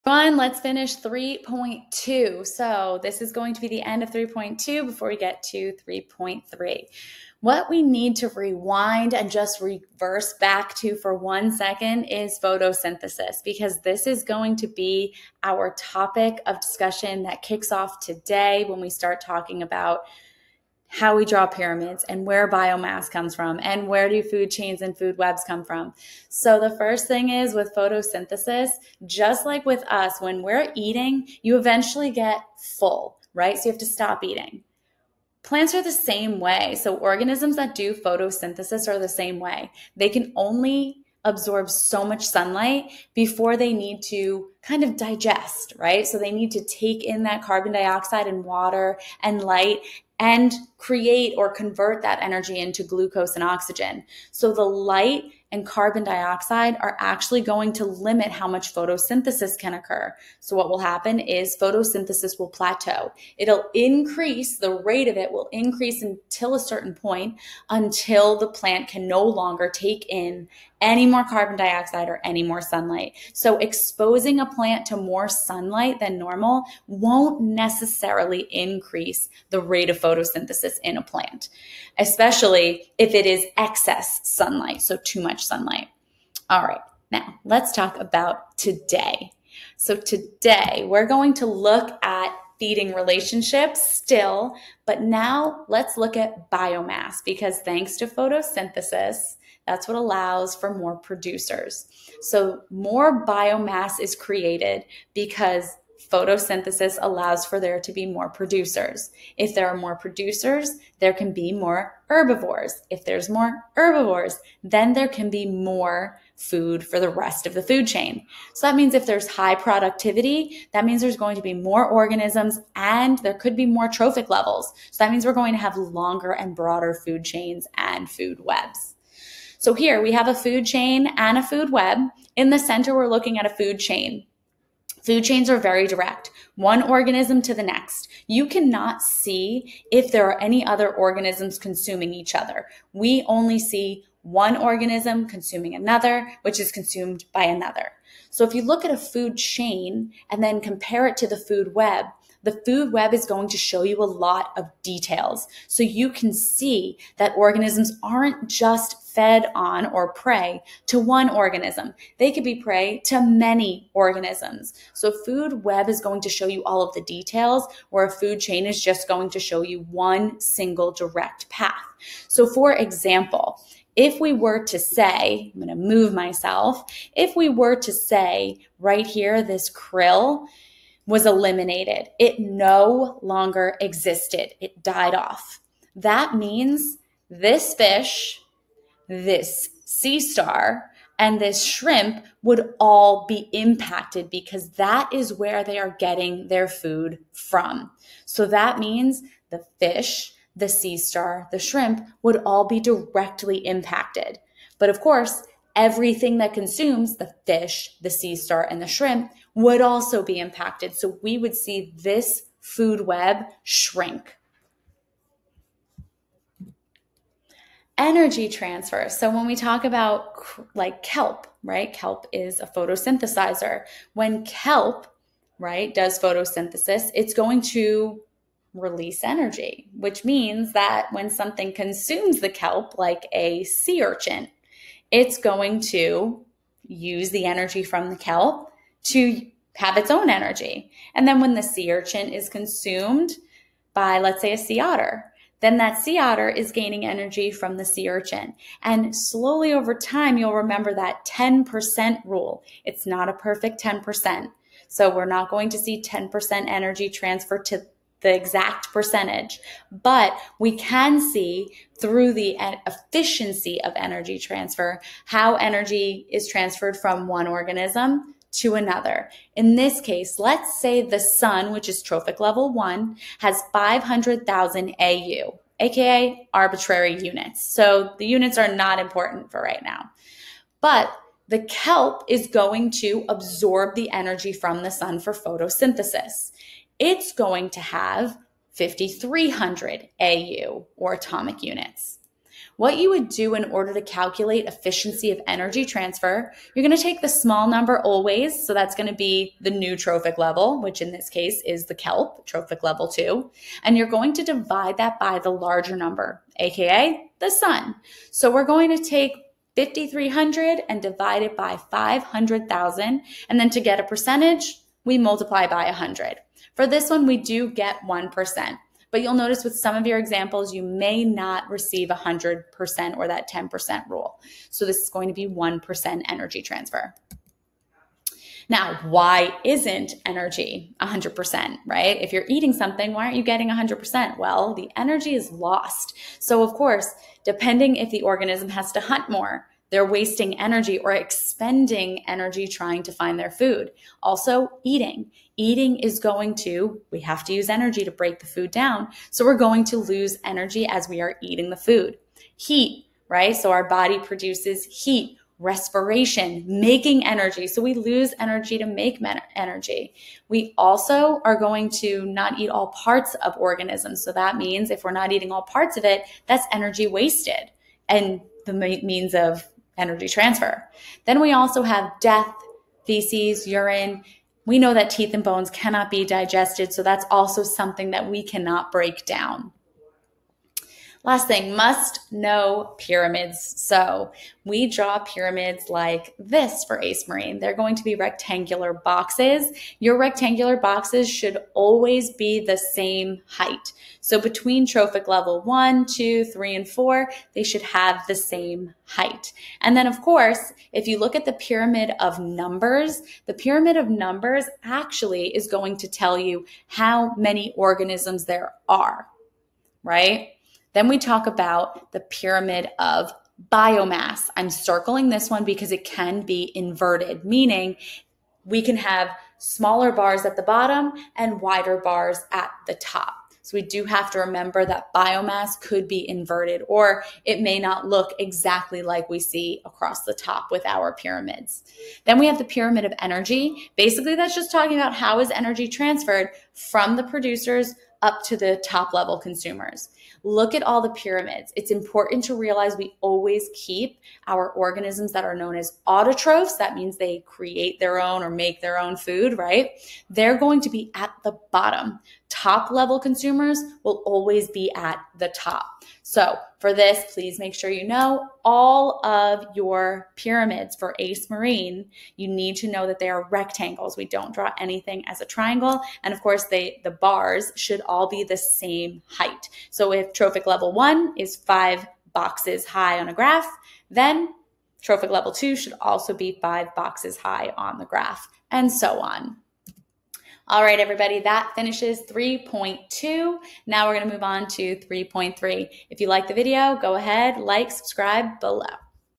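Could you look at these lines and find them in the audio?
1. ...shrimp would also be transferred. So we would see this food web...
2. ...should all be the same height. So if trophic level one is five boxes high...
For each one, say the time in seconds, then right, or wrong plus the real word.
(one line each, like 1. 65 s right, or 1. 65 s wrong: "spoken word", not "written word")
1. 208 s wrong: "impacted", not "transferred"
2. 467 s right.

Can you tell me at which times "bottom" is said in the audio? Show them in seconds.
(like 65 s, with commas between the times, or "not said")
420 s, 451 s.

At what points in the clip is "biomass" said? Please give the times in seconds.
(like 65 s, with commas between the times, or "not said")
22 s, 96 s, 103 s, 413 s, 425 s.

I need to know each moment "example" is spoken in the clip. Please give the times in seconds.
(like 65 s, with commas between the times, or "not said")
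172 s, 320 s.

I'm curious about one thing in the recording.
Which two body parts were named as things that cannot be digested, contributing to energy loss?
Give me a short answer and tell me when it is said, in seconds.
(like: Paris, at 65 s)
teeth and bones, at 375 s.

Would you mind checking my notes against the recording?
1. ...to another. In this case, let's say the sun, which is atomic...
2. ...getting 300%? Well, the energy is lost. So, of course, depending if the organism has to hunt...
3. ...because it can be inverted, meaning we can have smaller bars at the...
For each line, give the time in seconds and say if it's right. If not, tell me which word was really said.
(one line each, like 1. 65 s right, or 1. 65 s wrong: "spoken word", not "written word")
1. 268 s wrong: "trophic", not "atomic"
2. 333 s wrong: "100", not "300"
3. 415 s right.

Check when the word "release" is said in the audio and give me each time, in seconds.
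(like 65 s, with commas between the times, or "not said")
228 s.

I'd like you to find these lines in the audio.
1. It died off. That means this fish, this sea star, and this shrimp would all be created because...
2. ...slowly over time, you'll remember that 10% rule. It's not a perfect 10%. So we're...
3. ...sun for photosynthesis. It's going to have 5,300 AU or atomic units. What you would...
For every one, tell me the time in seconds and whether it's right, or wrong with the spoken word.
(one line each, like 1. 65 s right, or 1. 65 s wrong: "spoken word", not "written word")
1. 184 s wrong: "impacted", not "created"
2. 249 s right
3. 284 s right.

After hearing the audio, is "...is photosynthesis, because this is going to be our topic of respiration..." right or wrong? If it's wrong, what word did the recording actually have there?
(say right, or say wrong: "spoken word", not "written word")
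wrong: "discussion", not "respiration".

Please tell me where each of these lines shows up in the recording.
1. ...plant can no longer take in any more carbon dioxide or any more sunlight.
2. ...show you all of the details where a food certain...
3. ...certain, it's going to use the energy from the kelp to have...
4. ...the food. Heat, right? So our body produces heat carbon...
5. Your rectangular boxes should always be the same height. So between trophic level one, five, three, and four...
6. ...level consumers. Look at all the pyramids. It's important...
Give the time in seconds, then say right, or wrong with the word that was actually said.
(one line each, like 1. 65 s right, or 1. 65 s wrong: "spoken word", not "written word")
1. 68 s right
2. 166 s wrong: "chain", not "certain"
3. 234 s wrong: "urchin", not "certain"
4. 351 s wrong: "respiration", not "carbon"
5. 389 s wrong: "two", not "five"
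6. 439 s right.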